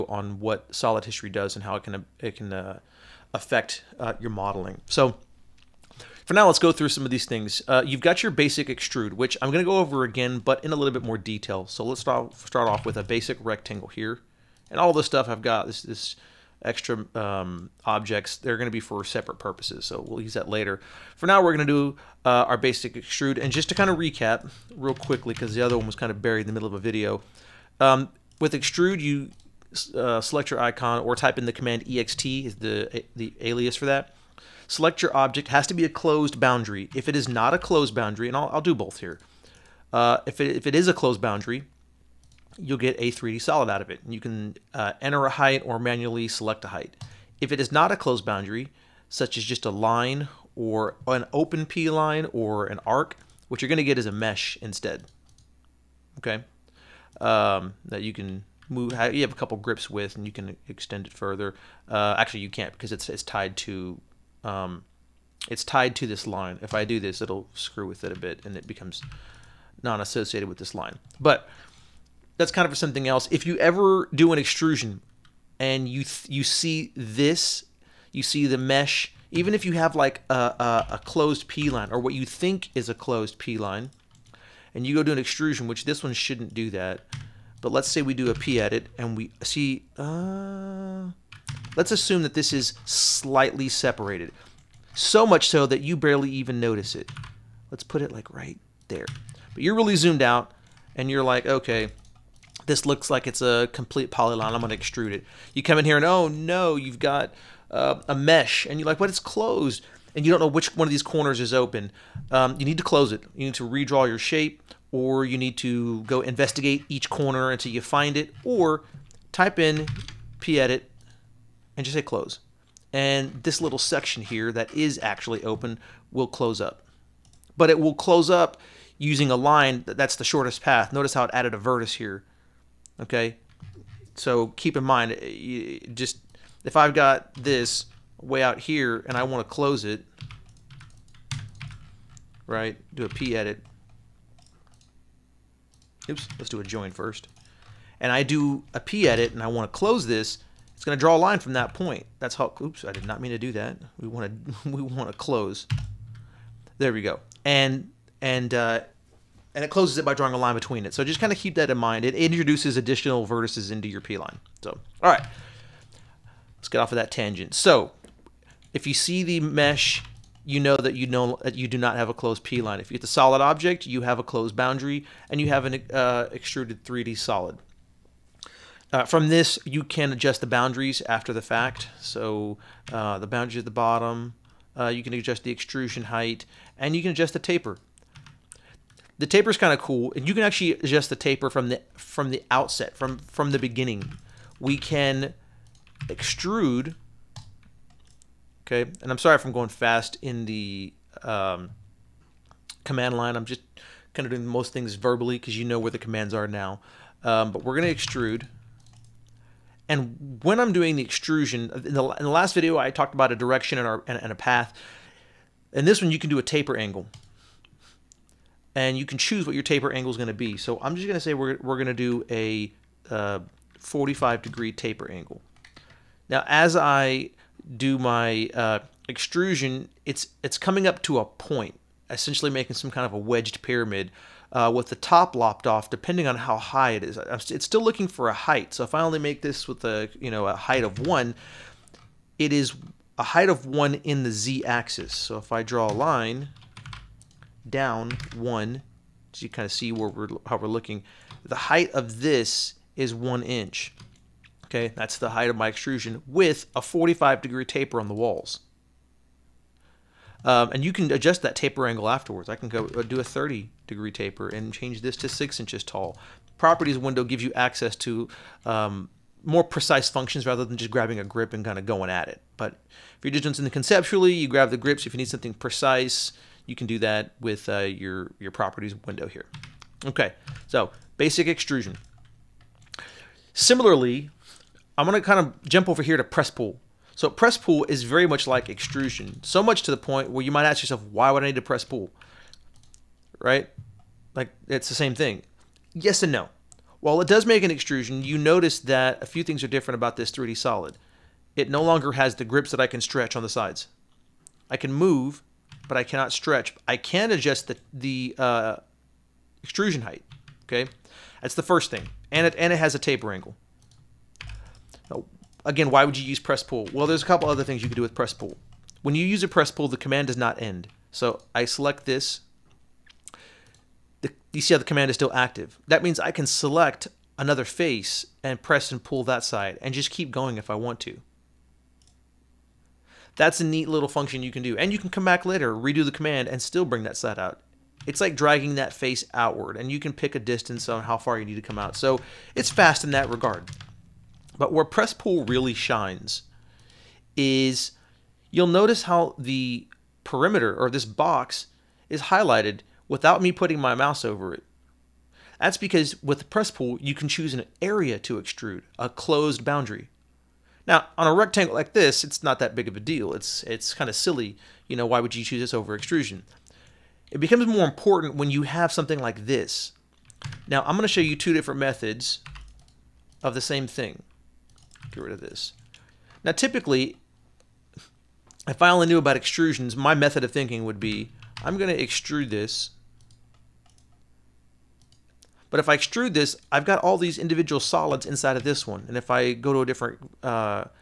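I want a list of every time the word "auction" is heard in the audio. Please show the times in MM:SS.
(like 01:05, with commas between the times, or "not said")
not said.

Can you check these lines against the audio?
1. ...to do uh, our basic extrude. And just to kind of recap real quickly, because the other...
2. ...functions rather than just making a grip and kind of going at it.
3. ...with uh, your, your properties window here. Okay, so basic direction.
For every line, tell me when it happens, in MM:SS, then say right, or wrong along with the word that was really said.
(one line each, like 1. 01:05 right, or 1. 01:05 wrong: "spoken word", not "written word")
1. 00:21 right
2. 04:30 wrong: "grabbing", not "making"
3. 04:37 wrong: "extrusion", not "direction".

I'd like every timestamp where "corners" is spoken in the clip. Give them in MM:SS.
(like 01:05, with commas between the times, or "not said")
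01:51, 01:57.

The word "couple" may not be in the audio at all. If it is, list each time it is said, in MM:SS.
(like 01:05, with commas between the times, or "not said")
00:59, 05:17.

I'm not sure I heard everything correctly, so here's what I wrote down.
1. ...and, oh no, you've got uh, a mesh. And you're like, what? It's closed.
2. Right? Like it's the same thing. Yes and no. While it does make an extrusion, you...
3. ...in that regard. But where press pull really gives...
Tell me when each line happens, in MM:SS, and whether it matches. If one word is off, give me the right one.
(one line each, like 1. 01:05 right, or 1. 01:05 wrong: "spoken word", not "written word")
1. 01:45 right
2. 04:53 right
3. 05:43 wrong: "shines", not "gives".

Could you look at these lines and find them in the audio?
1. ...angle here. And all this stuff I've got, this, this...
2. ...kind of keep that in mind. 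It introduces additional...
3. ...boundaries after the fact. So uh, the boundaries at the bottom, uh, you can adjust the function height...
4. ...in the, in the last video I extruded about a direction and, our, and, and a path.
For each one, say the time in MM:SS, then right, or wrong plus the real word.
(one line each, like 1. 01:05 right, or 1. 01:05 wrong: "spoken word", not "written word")
1. 00:13 wrong: "rectangle", not "angle"
2. 02:41 right
3. 03:00 wrong: "extrusion", not "function"
4. 03:31 wrong: "talked", not "extruded".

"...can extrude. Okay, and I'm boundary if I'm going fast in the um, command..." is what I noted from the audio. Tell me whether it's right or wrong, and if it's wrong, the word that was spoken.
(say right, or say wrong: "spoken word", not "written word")
wrong: "sorry", not "boundary".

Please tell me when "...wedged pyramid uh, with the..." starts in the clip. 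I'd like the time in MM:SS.
03:53.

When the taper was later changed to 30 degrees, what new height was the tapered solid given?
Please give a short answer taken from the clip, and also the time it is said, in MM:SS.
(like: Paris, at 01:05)
6 inches, at 04:25.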